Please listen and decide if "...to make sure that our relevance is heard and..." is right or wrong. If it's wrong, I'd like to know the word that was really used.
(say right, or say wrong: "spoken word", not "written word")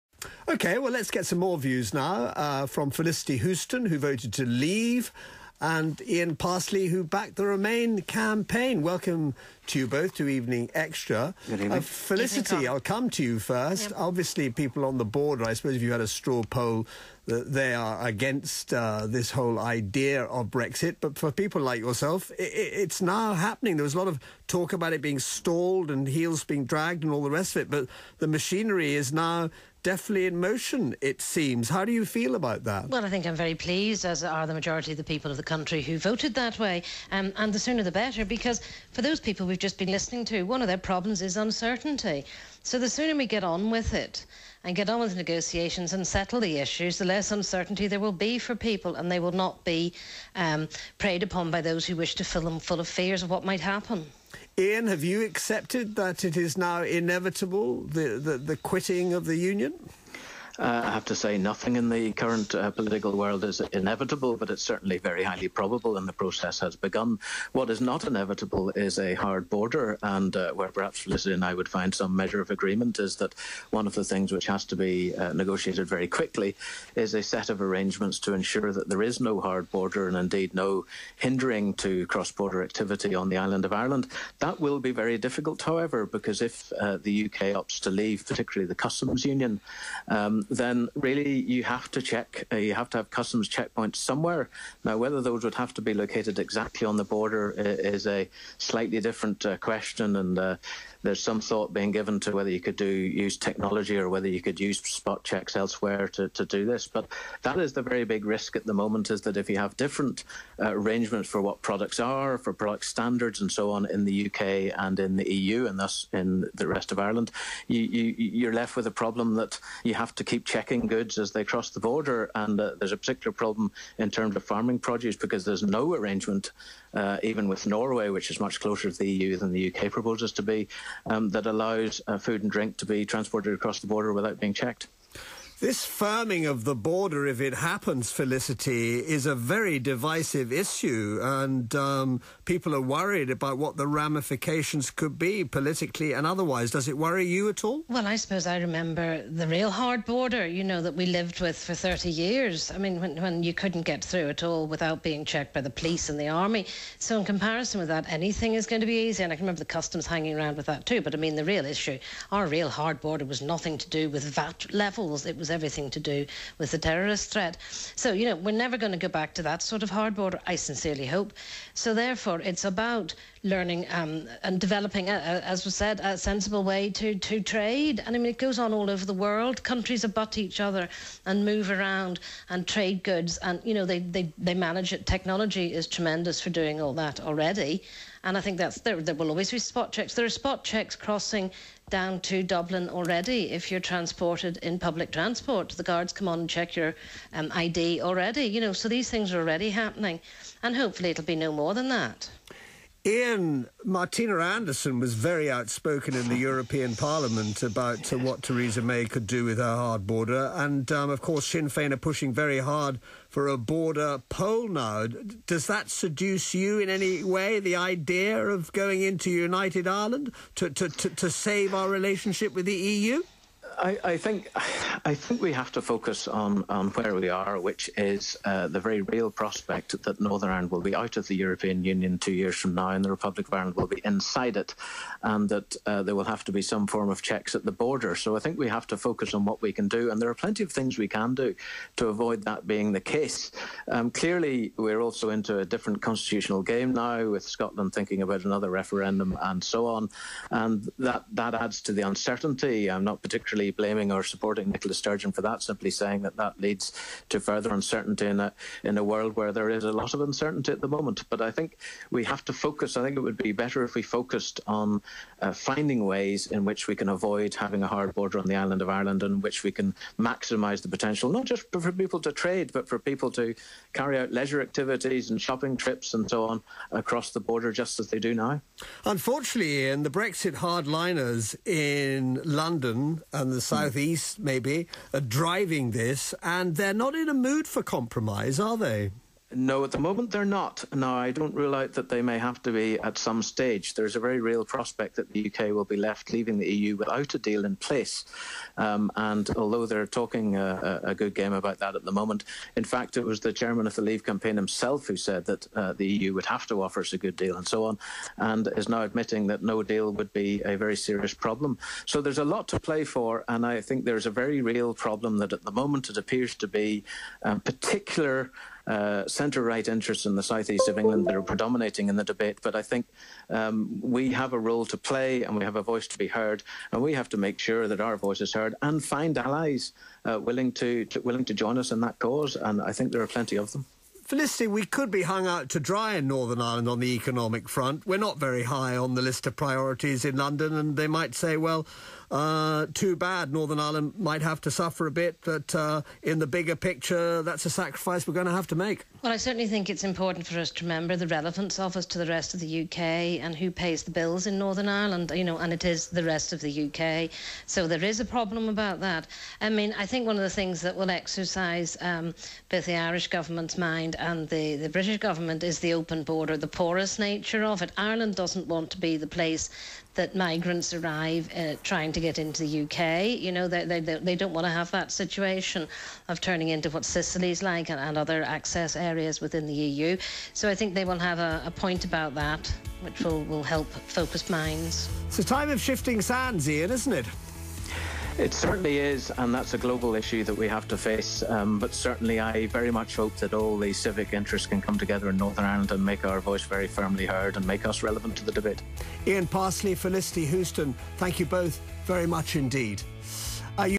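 wrong: "voice", not "relevance".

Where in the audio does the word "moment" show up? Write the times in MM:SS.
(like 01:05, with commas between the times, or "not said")
01:48, 04:20, 04:49, 05:02, 05:15.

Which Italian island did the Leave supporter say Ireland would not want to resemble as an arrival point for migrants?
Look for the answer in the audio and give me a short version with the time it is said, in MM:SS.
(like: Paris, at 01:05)
Sicily, at 06:17.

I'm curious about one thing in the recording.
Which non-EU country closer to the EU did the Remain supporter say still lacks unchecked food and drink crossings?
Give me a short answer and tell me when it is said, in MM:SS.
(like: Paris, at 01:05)
Norway, at 02:07.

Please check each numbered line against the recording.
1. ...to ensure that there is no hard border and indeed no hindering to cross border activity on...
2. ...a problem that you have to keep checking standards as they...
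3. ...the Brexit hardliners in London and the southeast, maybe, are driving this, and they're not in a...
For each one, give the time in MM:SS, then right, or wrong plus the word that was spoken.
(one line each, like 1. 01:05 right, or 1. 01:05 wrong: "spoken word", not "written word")
1. 01:18 right
2. 01:58 wrong: "goods", not "standards"
3. 04:40 right.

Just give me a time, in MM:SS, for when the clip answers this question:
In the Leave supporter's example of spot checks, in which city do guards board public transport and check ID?
03:12.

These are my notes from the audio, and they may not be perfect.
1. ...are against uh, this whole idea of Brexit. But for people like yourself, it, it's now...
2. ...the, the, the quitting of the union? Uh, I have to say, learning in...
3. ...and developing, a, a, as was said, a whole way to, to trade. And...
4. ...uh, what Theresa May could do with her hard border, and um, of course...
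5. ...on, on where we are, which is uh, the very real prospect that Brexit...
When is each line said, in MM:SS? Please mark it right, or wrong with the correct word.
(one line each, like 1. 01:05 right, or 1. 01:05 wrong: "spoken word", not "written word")
1. 00:17 right
2. 00:57 wrong: "nothing", not "learning"
3. 02:54 wrong: "sensible", not "whole"
4. 03:28 right
5. 03:46 wrong: "Northern", not "Brexit".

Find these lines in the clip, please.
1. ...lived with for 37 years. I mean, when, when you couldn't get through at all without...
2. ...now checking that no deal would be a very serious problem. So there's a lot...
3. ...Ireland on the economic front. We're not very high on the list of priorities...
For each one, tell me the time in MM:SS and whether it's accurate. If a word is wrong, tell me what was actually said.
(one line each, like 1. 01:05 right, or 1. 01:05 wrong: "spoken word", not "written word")
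1. 02:31 wrong: "30", not "37"
2. 05:08 wrong: "admitting", not "checking"
3. 05:36 right.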